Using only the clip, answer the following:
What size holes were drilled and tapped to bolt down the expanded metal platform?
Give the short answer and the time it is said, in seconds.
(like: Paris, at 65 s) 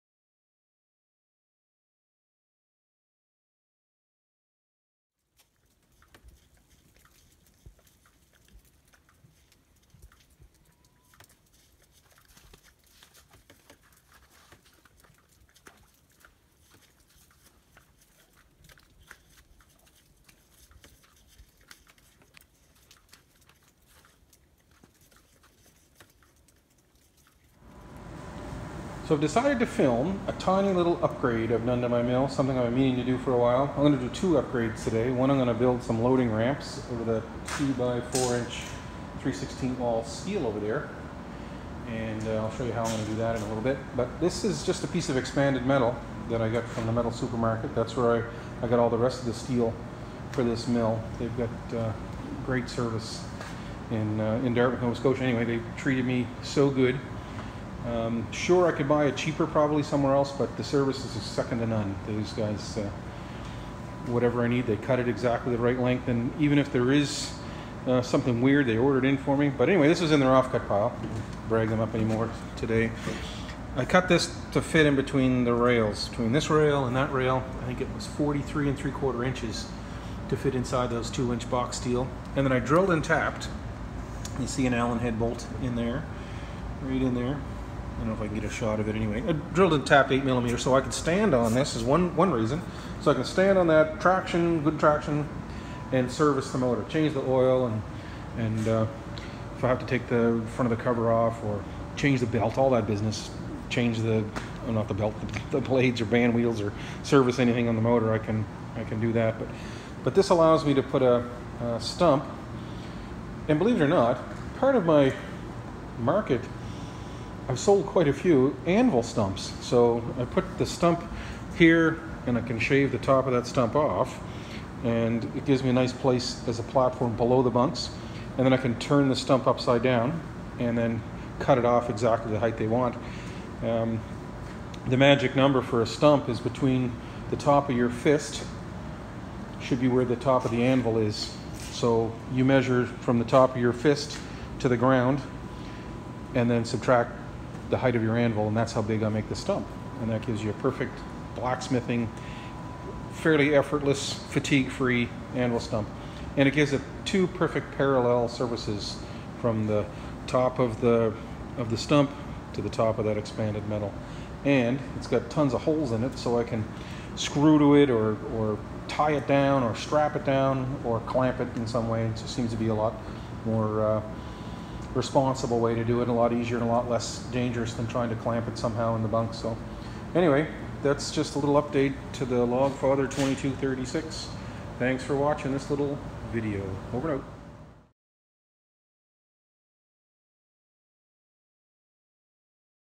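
8 millimeters, at 90 s.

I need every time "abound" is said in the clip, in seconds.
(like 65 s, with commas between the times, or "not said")
not said.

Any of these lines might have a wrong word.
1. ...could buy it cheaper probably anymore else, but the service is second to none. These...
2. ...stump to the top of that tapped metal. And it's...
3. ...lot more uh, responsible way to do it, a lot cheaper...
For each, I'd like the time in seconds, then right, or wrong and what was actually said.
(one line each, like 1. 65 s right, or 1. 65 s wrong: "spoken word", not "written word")
1. 58 s wrong: "somewhere", not "anymore"
2. 161 s wrong: "expanded", not "tapped"
3. 172 s wrong: "easier", not "cheaper".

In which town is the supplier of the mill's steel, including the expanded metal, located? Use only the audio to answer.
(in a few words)
Dartmouth, Nova Scotia.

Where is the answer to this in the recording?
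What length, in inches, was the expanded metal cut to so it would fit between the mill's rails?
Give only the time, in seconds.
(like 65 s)
78 s.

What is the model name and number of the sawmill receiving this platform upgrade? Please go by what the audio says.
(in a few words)
Log Father 2236.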